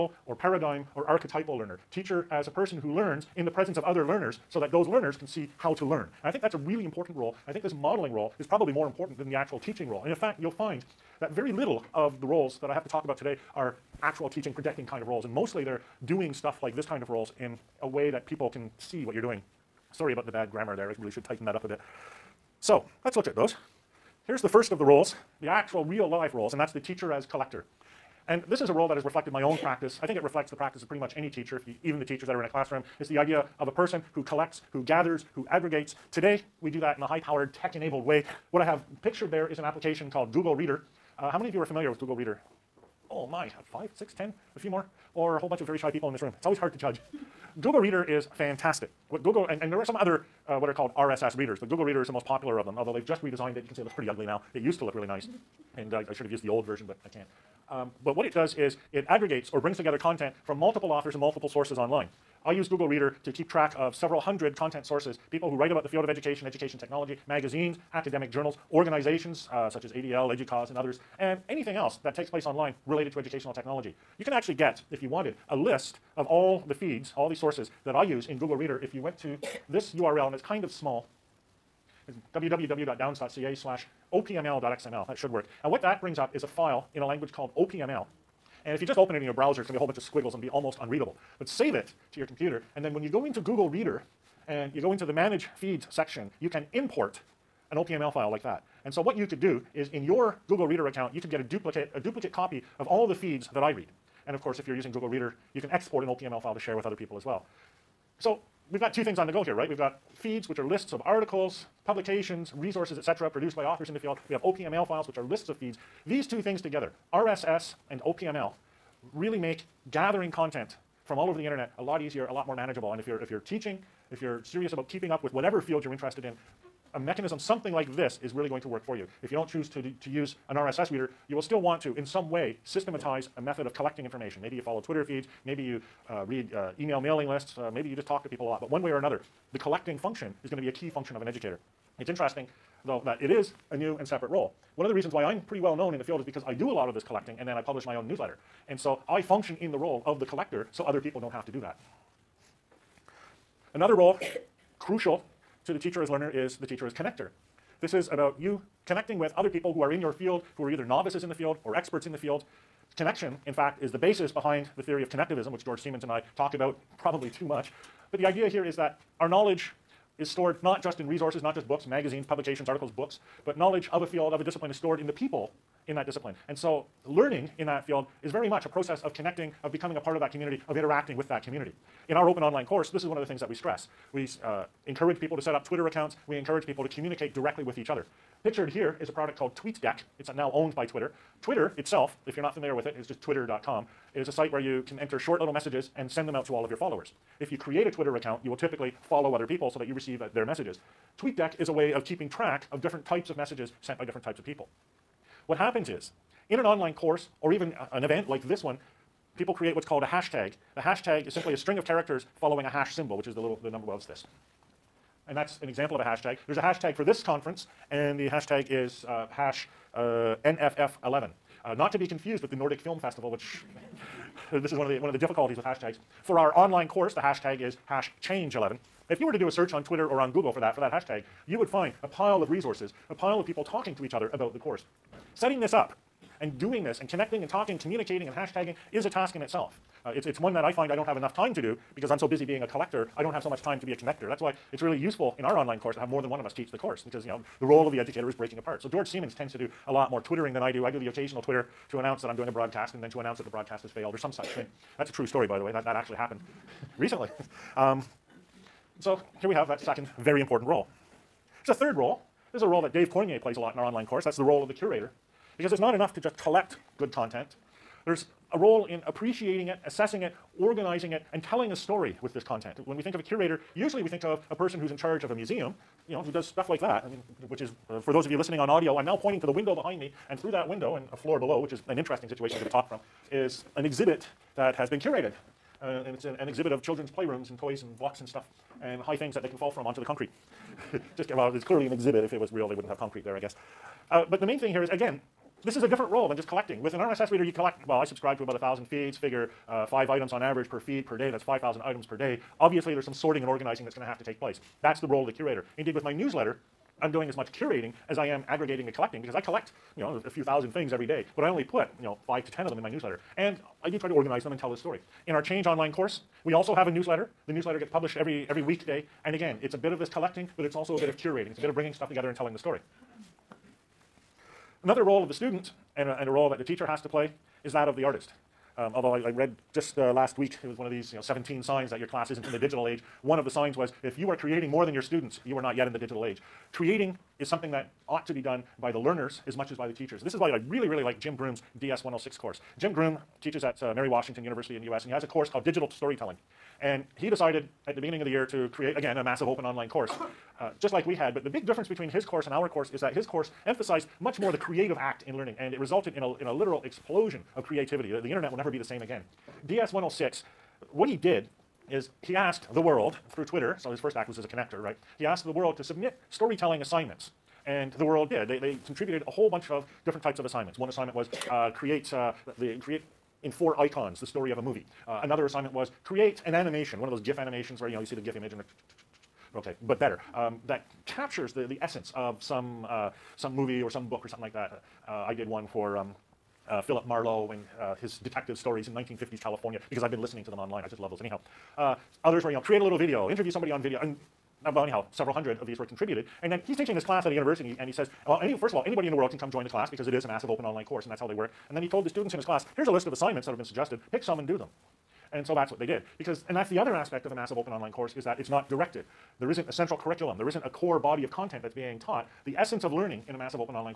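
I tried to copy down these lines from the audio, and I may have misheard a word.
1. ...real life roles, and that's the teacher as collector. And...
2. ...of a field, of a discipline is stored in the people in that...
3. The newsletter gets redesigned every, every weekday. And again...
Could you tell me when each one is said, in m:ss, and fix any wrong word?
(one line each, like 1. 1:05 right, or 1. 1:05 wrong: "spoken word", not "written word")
1. 0:25 right
2. 2:53 right
3. 5:17 wrong: "published", not "redesigned".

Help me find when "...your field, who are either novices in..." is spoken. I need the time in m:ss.
2:40.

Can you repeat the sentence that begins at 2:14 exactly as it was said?
Maybe you follow Twitter feeds, maybe you uh, read uh, email mailing lists, uh, maybe you just talk to people a lot.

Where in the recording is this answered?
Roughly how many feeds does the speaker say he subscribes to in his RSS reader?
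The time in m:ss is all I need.
4:58.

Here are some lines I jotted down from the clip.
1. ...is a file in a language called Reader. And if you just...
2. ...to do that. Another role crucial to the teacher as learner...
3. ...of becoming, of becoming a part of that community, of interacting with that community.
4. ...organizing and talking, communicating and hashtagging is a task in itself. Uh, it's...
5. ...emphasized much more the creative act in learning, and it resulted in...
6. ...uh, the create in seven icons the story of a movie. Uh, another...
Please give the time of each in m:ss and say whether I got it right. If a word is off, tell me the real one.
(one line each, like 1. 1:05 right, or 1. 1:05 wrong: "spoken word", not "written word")
1. 1:26 wrong: "OPML", not "Reader"
2. 2:31 right
3. 2:59 wrong: "connecting", not "becoming"
4. 3:57 wrong: "connecting", not "organizing"
5. 5:53 right
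6. 6:12 wrong: "four", not "seven".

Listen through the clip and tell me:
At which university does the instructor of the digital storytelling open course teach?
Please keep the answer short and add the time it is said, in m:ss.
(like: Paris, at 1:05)
Mary Washington University, at 5:43.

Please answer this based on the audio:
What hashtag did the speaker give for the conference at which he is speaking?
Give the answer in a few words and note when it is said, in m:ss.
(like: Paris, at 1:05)
NFF11, at 3:40.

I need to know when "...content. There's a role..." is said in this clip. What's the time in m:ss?
4:27.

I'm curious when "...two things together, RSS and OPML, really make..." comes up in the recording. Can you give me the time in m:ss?
1:56.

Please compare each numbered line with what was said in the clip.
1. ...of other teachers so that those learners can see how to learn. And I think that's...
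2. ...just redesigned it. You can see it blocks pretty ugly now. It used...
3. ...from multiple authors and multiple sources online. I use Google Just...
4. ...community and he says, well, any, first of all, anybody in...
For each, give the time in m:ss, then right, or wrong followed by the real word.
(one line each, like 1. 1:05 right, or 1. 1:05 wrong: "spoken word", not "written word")
1. 0:03 wrong: "learners", not "teachers"
2. 0:53 wrong: "looks", not "blocks"
3. 1:00 wrong: "Reader", not "Just"
4. 6:37 wrong: "university", not "community".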